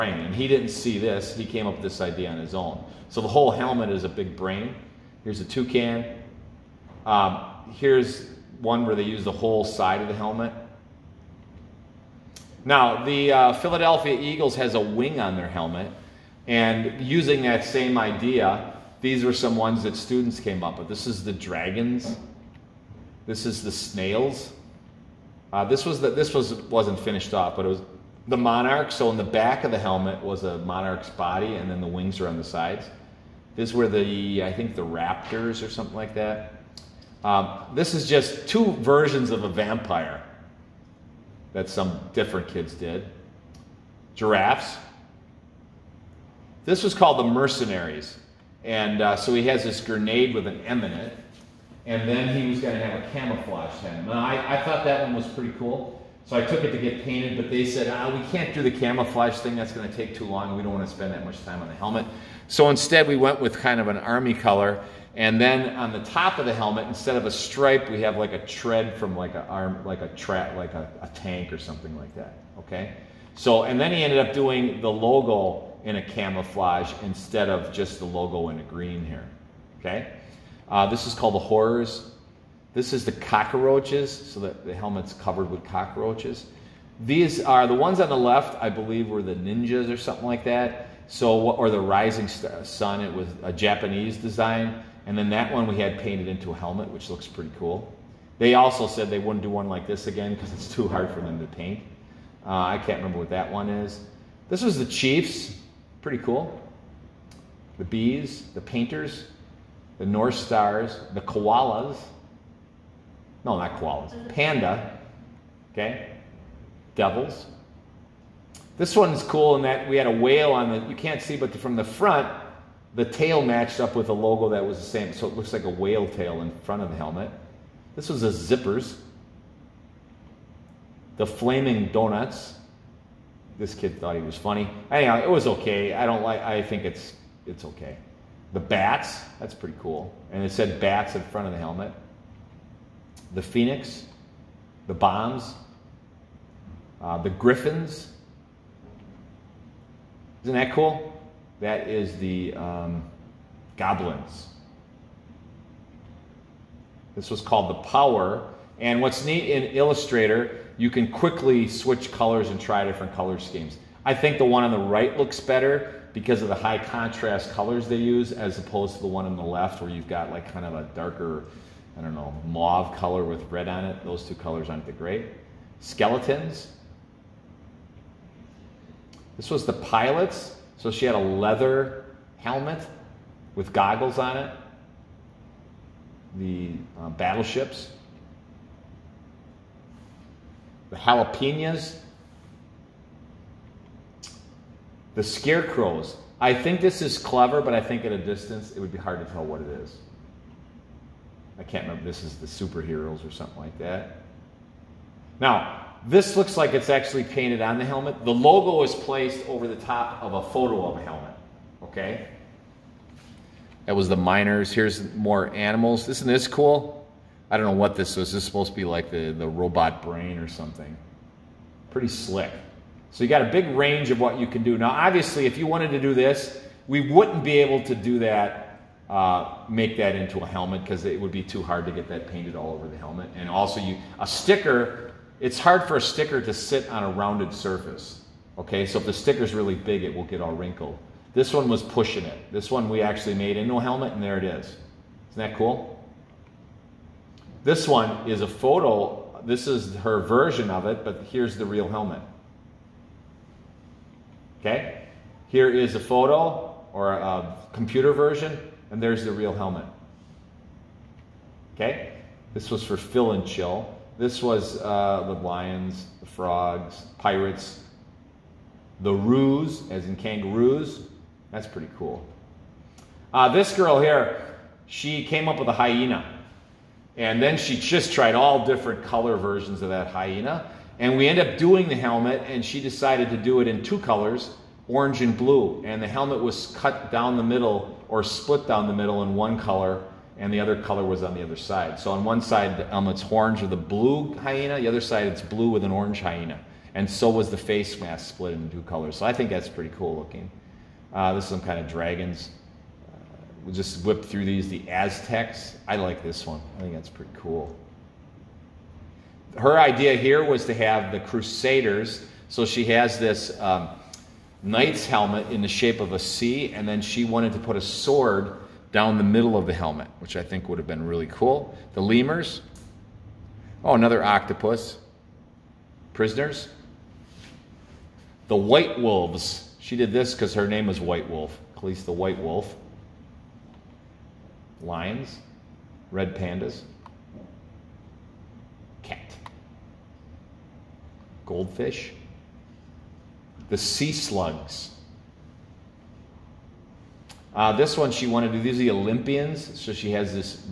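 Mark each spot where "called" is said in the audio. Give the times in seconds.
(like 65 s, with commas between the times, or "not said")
46 s, 81 s, 157 s.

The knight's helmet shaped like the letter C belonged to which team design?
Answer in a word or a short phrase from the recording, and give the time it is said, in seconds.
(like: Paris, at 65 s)
Crusaders, at 311 s.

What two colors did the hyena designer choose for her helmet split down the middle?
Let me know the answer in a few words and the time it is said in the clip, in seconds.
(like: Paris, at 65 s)
orange and blue, at 284 s.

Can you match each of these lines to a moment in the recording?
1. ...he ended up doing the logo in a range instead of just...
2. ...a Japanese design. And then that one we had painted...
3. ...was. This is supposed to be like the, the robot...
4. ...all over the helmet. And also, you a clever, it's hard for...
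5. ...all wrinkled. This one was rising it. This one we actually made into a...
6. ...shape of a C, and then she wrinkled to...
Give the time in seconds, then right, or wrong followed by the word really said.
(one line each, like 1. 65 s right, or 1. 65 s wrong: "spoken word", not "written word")
1. 73 s wrong: "camouflage", not "range"
2. 93 s right
3. 218 s right
4. 232 s wrong: "sticker", not "clever"
5. 240 s wrong: "pushing", not "rising"
6. 315 s wrong: "wanted", not "wrinkled".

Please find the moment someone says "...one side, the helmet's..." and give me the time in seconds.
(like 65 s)
292 s.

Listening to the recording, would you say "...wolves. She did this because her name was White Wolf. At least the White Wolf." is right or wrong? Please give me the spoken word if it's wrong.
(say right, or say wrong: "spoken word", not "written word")
right.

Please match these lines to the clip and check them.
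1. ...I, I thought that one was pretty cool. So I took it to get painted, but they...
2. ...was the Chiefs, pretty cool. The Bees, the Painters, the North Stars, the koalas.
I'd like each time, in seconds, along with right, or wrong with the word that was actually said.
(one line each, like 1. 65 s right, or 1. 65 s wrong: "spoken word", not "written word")
1. 54 s right
2. 104 s right.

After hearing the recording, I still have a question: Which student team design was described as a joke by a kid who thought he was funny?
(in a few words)
flaming donuts.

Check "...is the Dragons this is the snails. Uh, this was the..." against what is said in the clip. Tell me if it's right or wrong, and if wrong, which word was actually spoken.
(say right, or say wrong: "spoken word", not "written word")
right.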